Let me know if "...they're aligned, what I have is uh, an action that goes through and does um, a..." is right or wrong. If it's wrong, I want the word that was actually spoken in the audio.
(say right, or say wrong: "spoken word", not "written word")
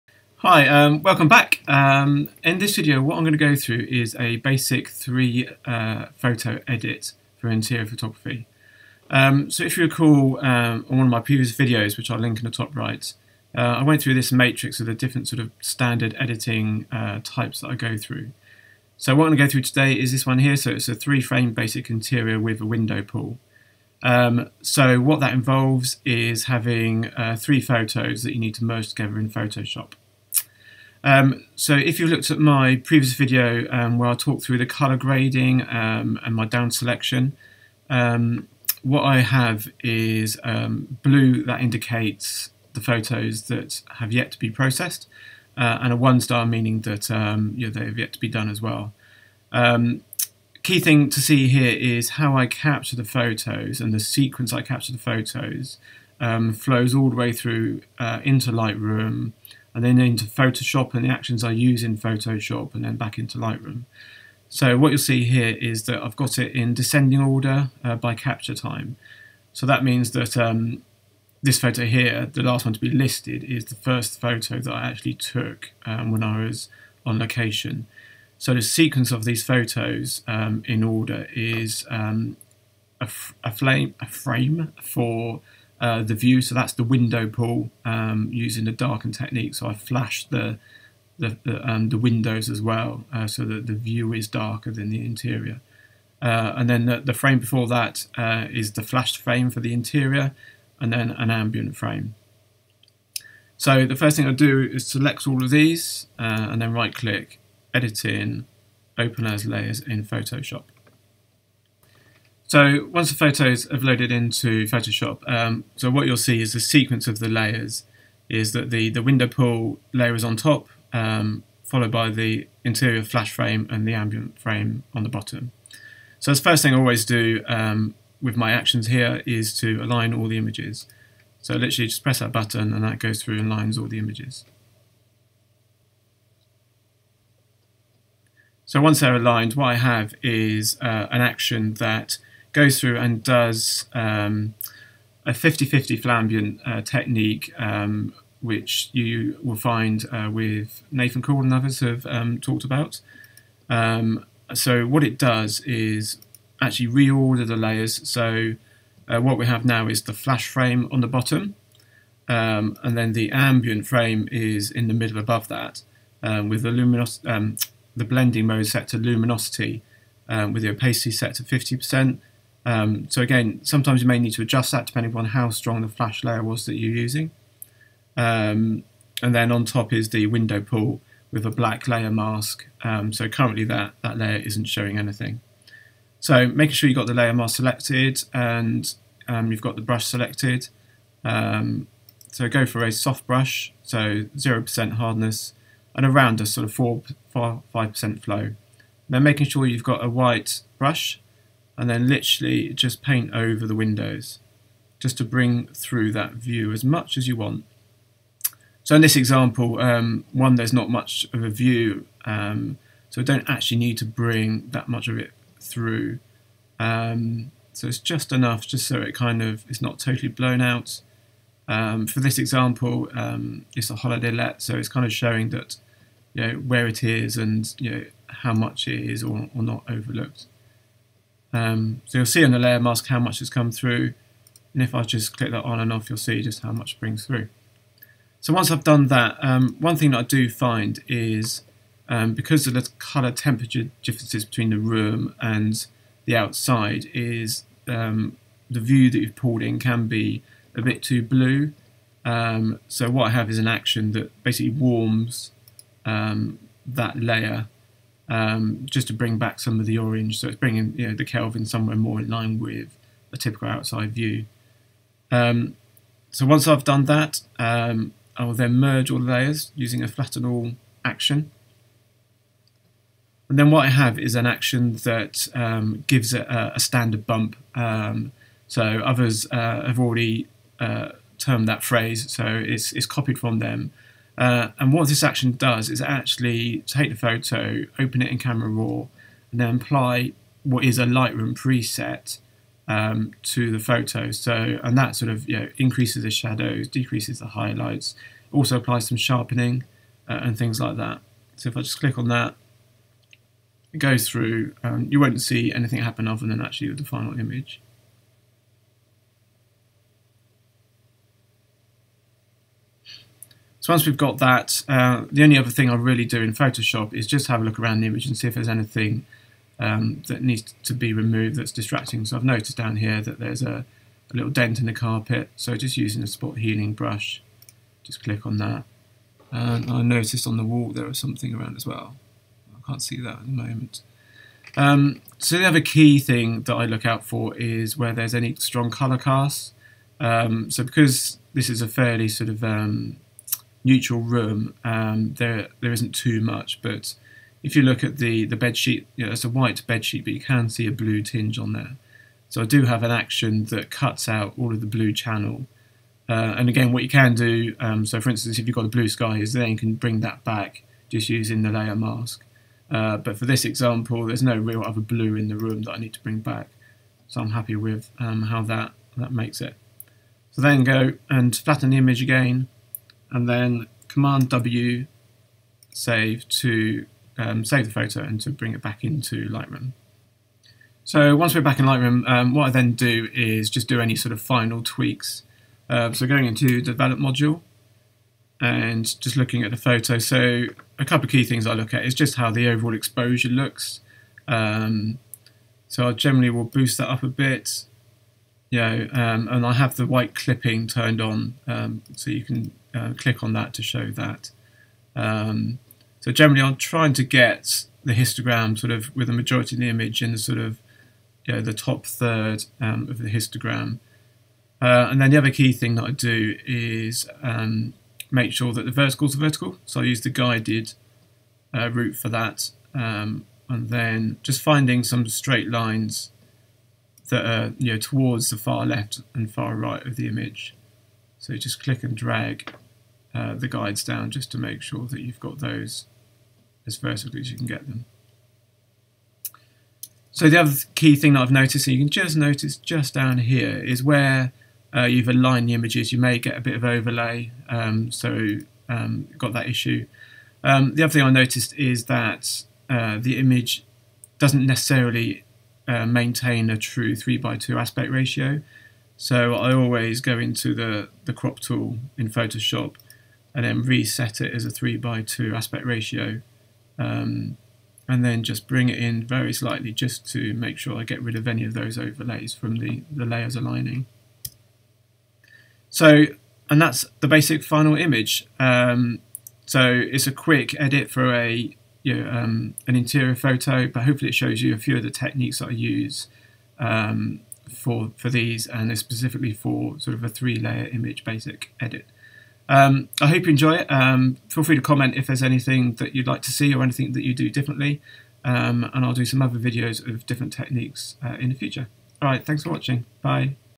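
right.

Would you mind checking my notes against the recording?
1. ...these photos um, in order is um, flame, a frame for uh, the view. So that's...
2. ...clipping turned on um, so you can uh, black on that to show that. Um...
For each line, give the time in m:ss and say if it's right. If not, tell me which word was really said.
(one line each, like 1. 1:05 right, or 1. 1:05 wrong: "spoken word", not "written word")
1. 1:19 right
2. 6:40 wrong: "click", not "black".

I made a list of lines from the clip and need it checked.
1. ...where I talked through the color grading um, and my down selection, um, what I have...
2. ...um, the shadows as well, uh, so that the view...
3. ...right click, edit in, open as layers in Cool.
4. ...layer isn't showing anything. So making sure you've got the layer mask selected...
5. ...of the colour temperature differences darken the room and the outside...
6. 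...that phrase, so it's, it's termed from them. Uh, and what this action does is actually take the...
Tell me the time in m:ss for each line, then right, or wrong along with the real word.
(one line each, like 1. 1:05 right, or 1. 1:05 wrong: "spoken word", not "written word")
1. 0:33 right
2. 1:31 wrong: "windows", not "shadows"
3. 1:46 wrong: "Photoshop", not "Cool"
4. 3:04 right
5. 4:02 wrong: "between", not "darken"
6. 4:41 wrong: "copied", not "termed".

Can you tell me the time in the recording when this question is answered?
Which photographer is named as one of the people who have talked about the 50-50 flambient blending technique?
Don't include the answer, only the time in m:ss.
2:30.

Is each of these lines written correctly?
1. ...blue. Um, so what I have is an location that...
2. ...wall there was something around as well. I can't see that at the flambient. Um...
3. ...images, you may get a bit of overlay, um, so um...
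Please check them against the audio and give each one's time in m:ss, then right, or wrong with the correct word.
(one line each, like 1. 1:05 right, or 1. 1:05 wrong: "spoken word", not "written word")
1. 4:11 wrong: "action", not "location"
2. 5:30 wrong: "moment", not "flambient"
3. 7:25 right.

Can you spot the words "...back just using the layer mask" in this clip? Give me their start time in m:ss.
6:00.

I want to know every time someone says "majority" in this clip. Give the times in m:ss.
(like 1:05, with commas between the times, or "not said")
6:49.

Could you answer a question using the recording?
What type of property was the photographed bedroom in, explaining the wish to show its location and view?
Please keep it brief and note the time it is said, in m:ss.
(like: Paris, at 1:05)
Holiday let, at 3:43.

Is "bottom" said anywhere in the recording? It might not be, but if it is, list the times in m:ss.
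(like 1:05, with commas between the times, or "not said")
2:05, 2:41.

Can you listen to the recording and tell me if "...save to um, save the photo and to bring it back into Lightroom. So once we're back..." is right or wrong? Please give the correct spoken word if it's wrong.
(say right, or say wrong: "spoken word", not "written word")
right.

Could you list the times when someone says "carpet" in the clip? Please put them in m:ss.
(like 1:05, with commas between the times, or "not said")
5:24.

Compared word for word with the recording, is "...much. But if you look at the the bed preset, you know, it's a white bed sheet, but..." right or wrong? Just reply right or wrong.
wrong.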